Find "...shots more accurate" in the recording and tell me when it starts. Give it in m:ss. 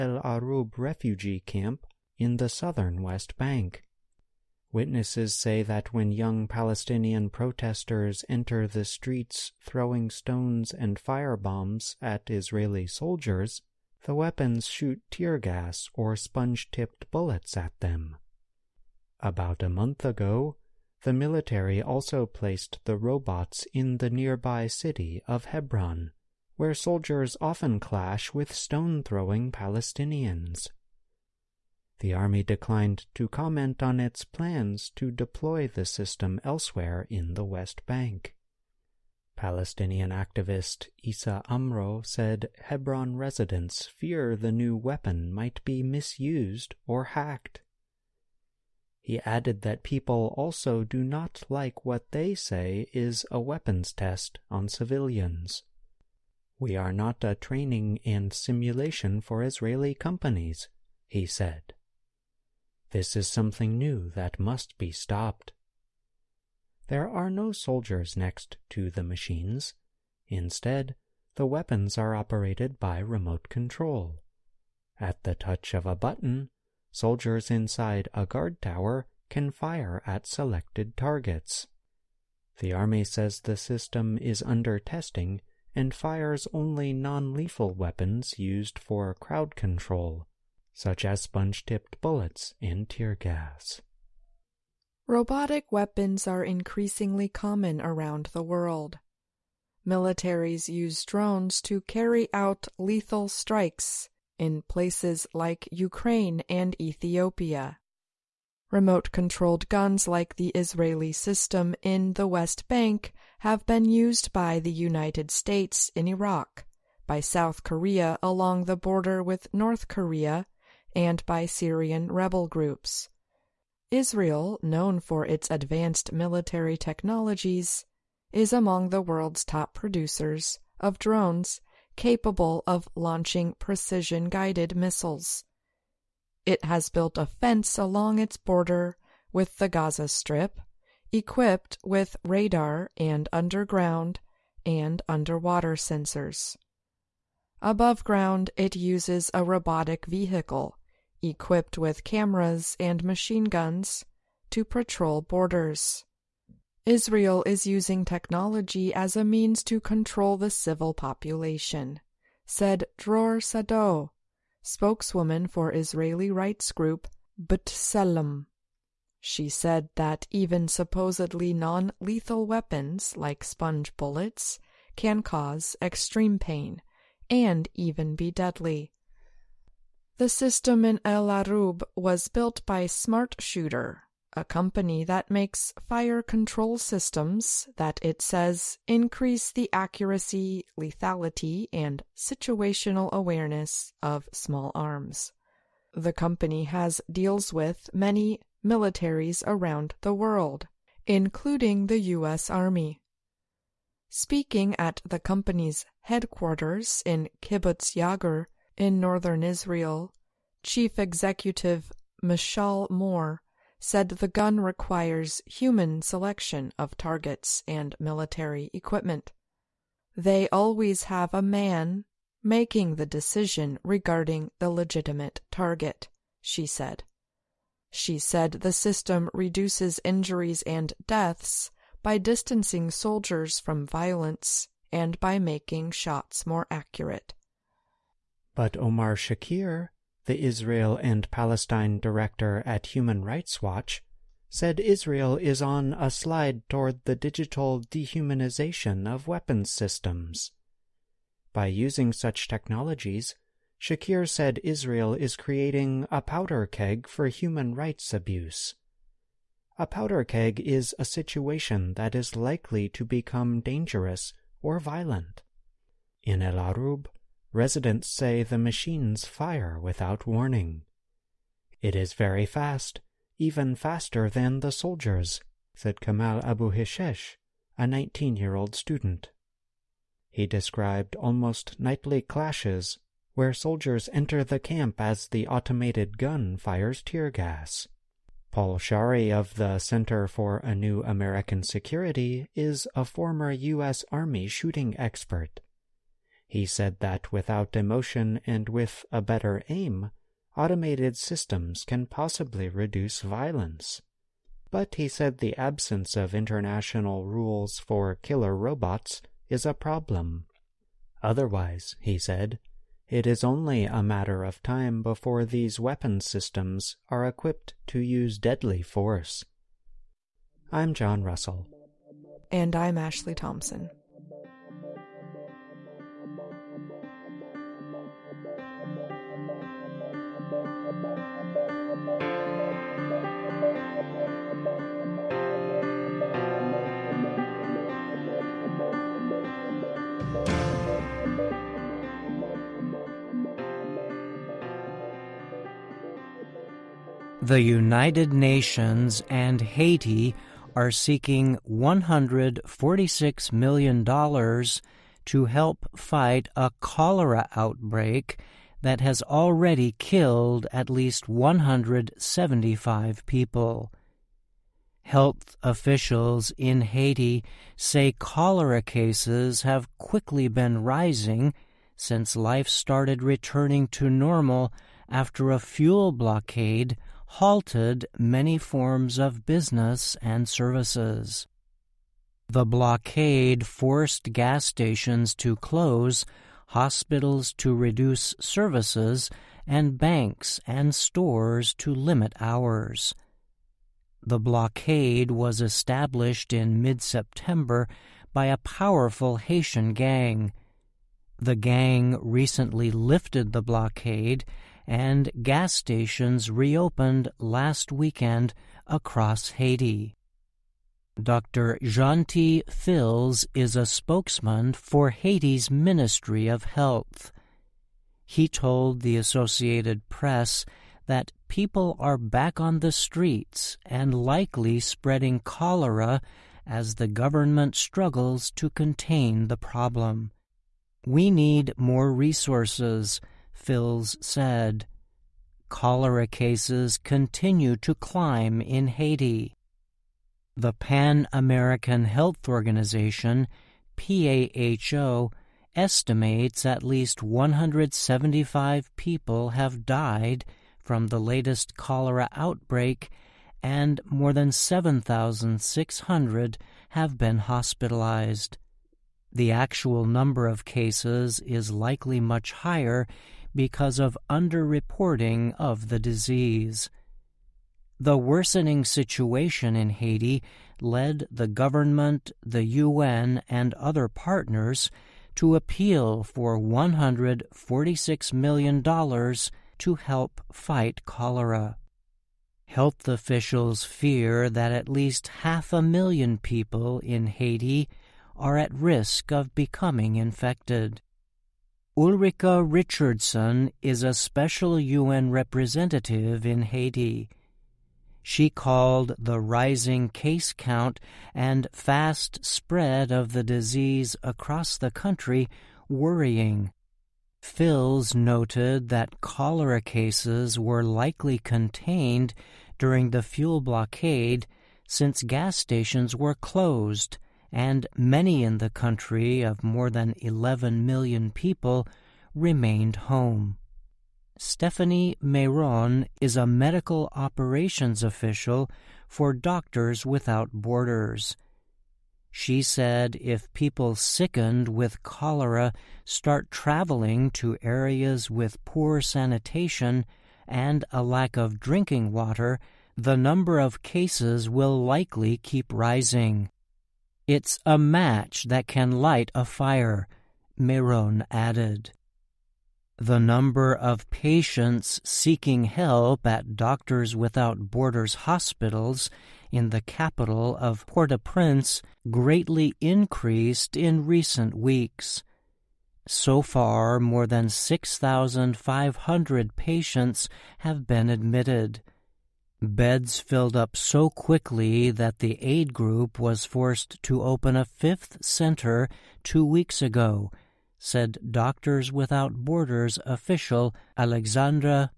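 3:55.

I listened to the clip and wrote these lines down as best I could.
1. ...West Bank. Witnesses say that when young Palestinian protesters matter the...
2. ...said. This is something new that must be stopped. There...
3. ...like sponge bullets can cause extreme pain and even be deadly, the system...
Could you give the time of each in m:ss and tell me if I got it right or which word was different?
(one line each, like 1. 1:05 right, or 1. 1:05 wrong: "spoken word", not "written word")
1. 0:03 wrong: "enter", not "matter"
2. 1:01 right
3. 2:53 right.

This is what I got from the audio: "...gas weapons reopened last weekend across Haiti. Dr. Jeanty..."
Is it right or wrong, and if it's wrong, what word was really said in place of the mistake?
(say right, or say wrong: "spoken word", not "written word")
wrong: "stations", not "weapons".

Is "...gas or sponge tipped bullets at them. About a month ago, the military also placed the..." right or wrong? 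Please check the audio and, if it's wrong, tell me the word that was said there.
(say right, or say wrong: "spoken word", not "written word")
right.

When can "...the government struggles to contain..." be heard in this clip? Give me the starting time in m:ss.
7:06.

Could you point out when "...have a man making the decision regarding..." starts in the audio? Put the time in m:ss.
3:41.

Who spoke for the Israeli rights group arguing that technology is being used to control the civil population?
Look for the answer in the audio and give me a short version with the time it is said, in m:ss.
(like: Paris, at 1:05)
Dror Sadot, at 2:42.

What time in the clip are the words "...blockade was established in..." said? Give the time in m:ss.
6:34.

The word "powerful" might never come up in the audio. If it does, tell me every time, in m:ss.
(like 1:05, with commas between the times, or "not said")
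6:38.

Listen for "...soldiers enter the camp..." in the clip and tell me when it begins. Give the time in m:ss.
4:43.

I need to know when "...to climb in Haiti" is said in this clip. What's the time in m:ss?
7:17.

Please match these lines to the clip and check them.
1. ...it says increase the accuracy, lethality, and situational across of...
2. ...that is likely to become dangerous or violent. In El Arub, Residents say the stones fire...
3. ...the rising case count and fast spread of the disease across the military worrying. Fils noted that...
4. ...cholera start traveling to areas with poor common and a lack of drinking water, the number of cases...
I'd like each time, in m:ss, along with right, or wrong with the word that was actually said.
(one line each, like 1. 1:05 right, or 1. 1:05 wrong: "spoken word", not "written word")
1. 3:08 wrong: "awareness", not "across"
2. 4:21 wrong: "machines", not "stones"
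3. 8:19 wrong: "country", not "military"
4. 8:55 wrong: "sanitation", not "common".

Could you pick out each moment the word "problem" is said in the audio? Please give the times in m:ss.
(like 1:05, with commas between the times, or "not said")
5:09, 7:09.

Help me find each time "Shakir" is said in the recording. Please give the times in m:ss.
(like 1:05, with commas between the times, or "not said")
3:59, 4:13.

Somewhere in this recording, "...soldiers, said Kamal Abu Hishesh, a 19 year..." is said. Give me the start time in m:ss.
4:34.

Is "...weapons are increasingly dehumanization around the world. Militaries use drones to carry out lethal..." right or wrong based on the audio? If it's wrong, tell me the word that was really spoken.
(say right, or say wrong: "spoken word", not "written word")
wrong: "common", not "dehumanization".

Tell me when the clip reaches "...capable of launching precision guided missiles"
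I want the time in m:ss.
2:11.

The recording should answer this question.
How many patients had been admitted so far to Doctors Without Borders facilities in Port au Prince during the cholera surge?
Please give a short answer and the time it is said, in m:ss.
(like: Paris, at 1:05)
more than 6,500, at 9:26.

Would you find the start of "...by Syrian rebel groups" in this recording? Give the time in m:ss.
2:01.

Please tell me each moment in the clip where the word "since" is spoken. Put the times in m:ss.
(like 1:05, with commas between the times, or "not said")
6:11, 8:34.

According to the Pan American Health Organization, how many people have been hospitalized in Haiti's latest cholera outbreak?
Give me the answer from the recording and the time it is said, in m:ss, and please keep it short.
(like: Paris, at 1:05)
more than 7,600, at 7:34.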